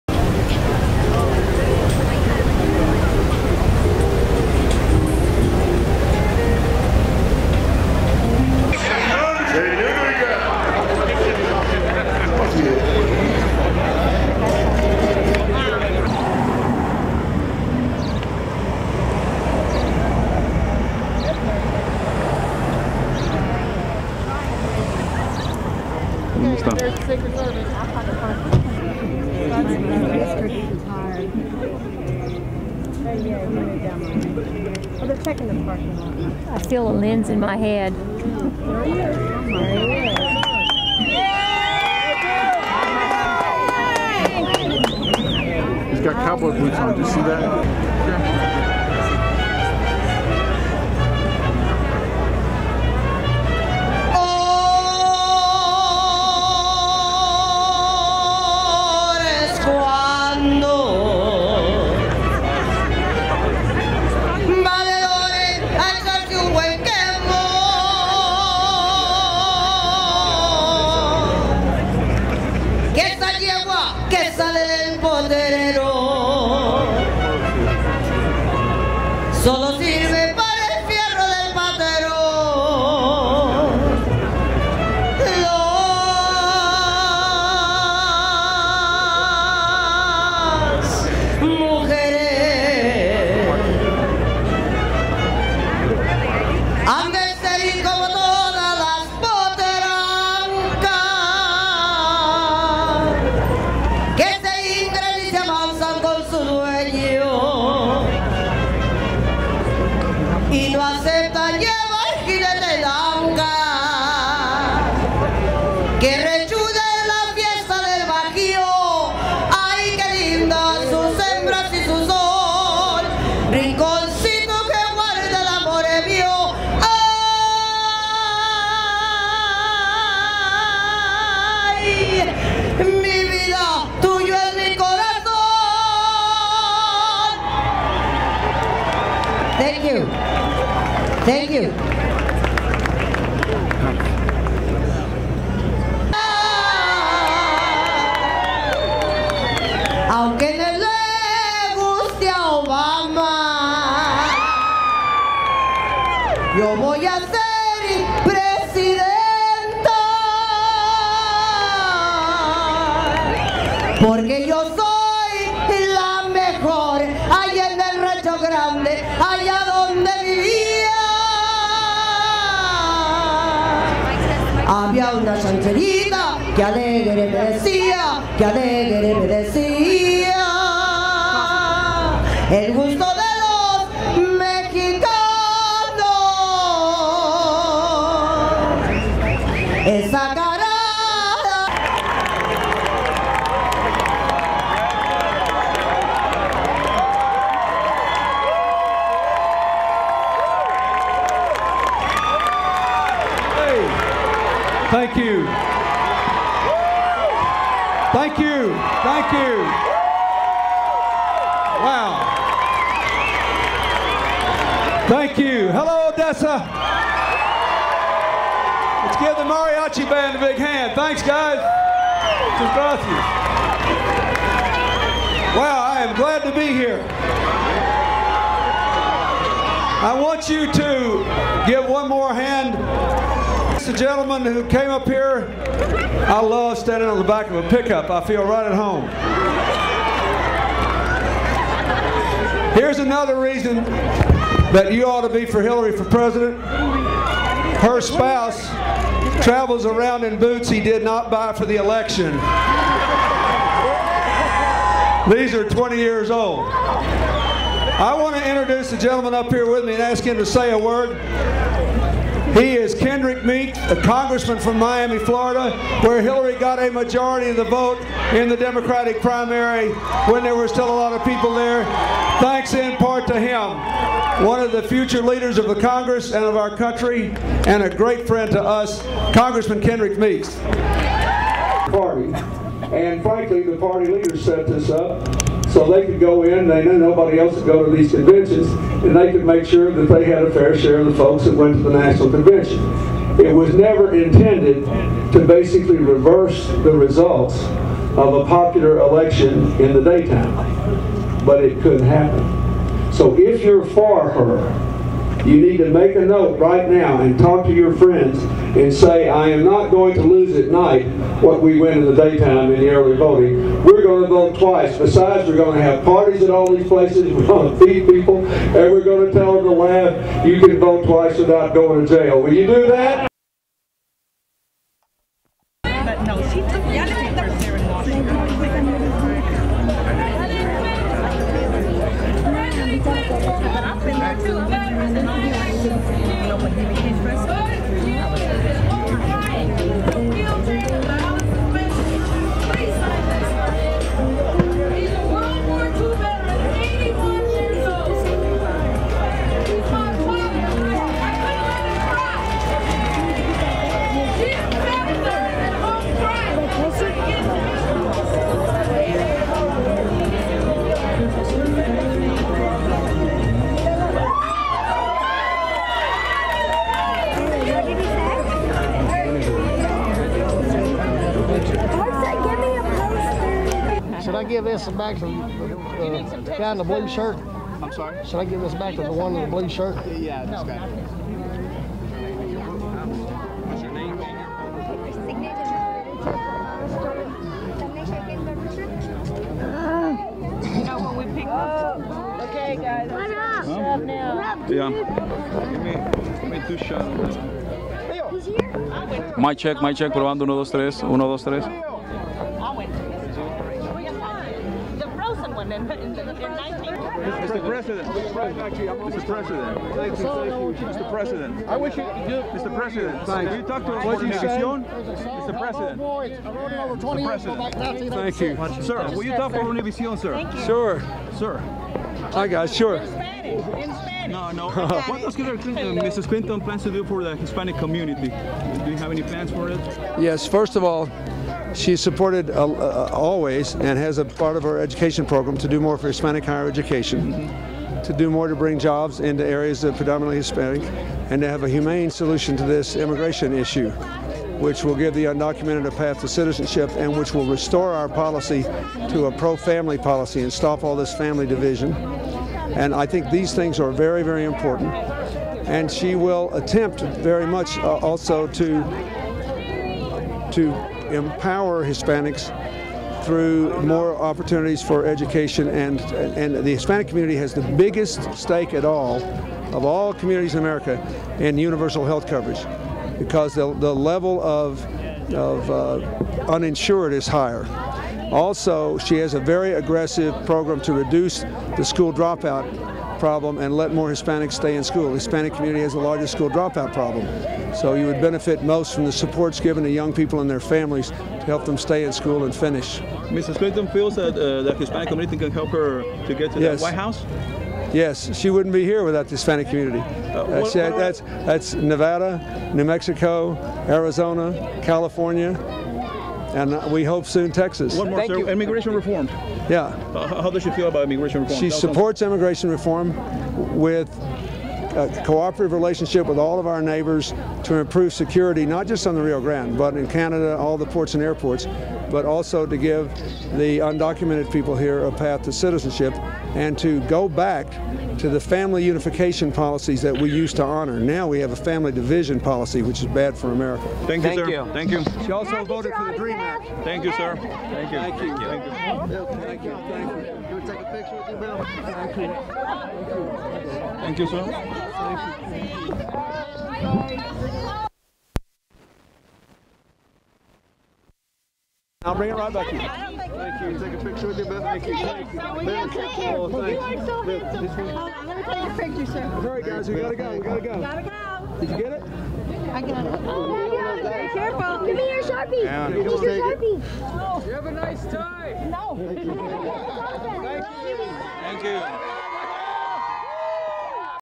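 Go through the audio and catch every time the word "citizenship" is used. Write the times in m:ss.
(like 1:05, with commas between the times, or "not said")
7:26, 8:45.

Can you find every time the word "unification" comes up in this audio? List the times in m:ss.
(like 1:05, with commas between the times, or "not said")
8:48.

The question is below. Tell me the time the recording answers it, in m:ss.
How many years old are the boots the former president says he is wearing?
4:15.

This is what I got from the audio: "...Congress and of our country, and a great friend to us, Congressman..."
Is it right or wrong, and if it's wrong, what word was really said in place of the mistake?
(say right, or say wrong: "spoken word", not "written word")
right.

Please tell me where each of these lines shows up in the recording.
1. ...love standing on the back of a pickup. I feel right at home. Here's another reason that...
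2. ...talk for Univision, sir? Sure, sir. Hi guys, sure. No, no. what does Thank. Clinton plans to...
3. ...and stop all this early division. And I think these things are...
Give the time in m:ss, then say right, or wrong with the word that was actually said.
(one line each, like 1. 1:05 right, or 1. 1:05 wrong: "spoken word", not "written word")
1. 3:56 right
2. 6:59 wrong: "Mrs", not "Thank"
3. 7:30 wrong: "family", not "early".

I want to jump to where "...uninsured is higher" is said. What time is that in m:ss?
7:56.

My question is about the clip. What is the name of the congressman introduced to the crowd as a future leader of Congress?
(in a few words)
Kendrick Meek.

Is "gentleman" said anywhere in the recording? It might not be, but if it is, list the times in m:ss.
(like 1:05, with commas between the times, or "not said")
3:53, 4:18.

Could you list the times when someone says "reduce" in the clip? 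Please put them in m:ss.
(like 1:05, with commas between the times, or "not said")
8:00.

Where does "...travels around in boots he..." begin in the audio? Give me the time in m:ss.
4:09.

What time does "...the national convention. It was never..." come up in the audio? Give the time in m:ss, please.
4:51.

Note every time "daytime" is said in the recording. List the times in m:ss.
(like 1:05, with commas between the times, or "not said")
5:00, 5:12.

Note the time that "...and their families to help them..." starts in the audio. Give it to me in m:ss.
8:10.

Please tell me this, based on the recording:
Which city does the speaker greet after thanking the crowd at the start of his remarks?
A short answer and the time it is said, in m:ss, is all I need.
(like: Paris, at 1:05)
Odessa, at 3:36.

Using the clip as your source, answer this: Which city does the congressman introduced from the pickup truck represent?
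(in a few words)
Miami.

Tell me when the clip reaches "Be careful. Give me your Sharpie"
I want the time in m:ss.
9:24.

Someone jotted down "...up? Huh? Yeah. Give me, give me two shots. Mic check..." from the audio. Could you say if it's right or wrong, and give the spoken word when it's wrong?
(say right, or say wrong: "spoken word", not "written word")
right.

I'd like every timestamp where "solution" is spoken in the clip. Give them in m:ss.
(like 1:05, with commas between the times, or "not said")
7:22.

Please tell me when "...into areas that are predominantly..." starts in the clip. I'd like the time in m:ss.
7:19.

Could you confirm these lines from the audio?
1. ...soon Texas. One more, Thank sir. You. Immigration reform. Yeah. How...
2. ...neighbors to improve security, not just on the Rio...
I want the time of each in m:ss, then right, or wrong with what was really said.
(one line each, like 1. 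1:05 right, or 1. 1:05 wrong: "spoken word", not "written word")
1. 8:27 right
2. 8:36 right.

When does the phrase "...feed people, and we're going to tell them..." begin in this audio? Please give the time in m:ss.
5:17.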